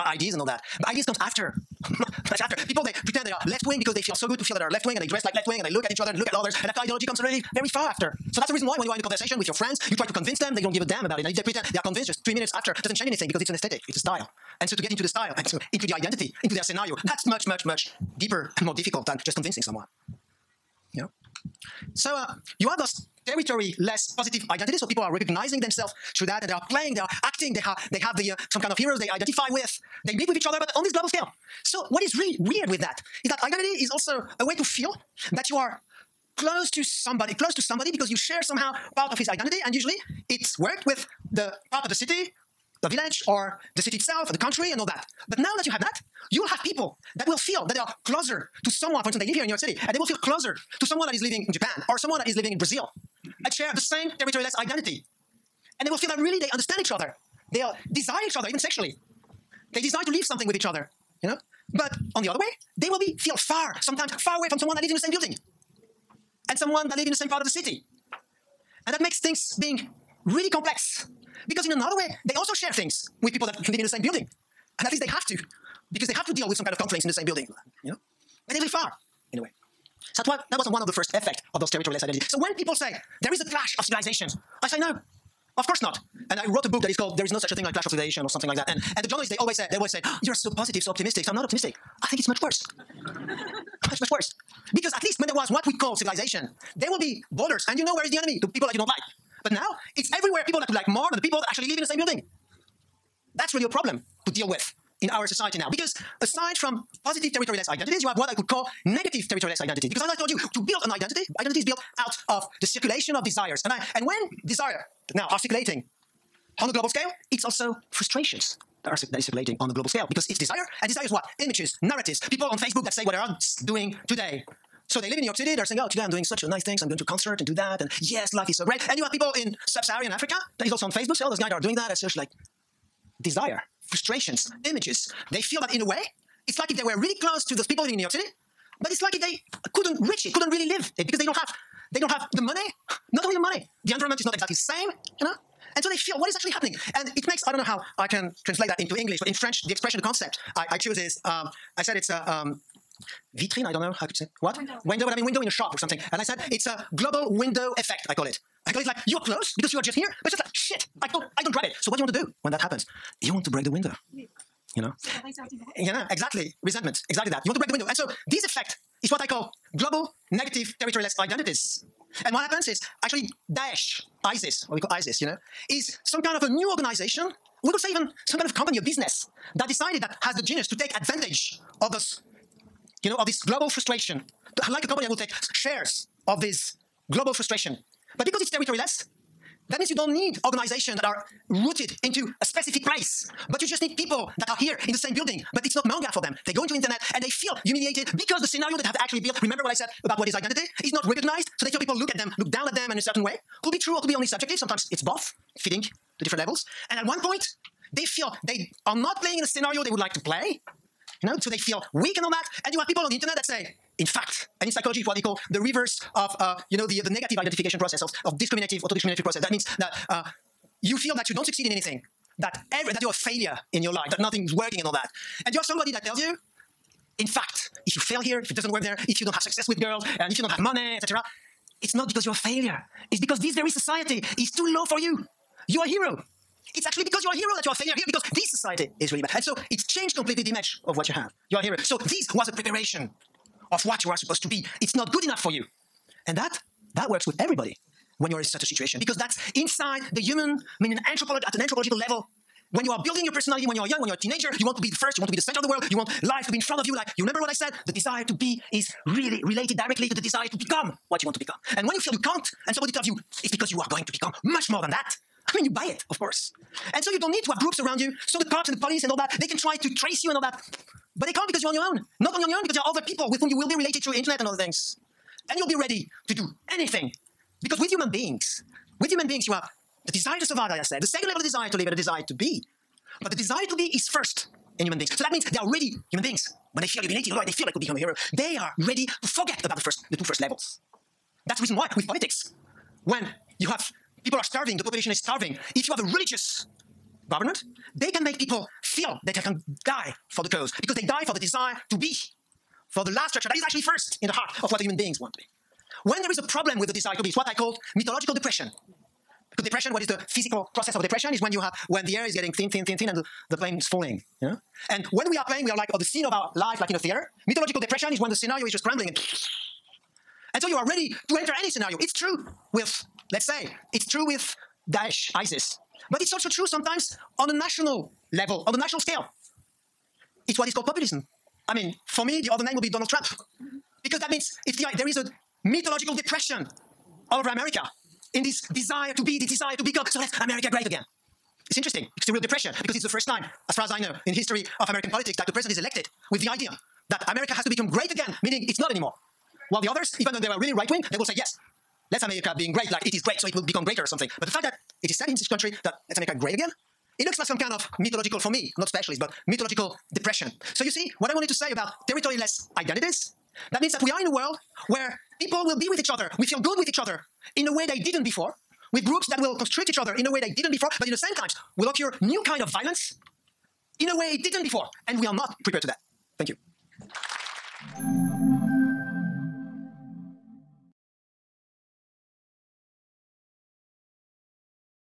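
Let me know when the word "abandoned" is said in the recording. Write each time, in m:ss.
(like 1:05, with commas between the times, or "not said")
not said.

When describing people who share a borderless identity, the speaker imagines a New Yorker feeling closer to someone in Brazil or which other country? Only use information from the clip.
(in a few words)
Japan.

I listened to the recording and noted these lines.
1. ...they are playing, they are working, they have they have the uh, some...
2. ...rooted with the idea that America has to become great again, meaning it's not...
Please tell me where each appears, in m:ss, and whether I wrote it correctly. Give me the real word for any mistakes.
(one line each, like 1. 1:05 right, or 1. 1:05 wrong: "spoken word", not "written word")
1. 0:26 wrong: "acting", not "working"
2. 5:45 wrong: "elected", not "rooted".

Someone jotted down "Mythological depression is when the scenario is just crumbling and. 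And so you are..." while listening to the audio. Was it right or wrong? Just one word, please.
right.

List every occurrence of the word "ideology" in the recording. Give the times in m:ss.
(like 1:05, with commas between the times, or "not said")
0:06.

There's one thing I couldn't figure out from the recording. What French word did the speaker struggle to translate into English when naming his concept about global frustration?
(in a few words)
vitrine.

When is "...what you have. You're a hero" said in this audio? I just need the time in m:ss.
4:00.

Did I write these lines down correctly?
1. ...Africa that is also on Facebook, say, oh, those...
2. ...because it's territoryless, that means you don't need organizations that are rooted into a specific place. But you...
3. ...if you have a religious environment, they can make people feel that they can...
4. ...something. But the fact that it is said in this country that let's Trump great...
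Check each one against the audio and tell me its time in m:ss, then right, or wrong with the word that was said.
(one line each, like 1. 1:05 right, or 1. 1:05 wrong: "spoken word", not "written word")
1. 2:10 right
2. 3:08 right
3. 4:55 wrong: "government", not "environment"
4. 5:54 wrong: "America", not "Trump".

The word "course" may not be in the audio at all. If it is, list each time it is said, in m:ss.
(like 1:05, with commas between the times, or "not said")
1:25, 4:26.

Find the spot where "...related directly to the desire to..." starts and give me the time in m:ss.
4:19.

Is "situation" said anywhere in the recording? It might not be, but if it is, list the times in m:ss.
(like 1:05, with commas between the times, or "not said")
4:08.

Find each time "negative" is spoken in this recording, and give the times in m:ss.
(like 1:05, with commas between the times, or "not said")
1:48, 2:50, 3:37.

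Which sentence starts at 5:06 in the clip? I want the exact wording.
When there is a problem with the desire to be, it's what I call mythological depression.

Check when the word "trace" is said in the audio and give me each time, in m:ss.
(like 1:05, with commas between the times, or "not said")
4:29.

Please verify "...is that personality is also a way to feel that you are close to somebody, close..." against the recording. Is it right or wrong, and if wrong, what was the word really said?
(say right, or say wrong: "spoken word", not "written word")
wrong: "identity", not "personality".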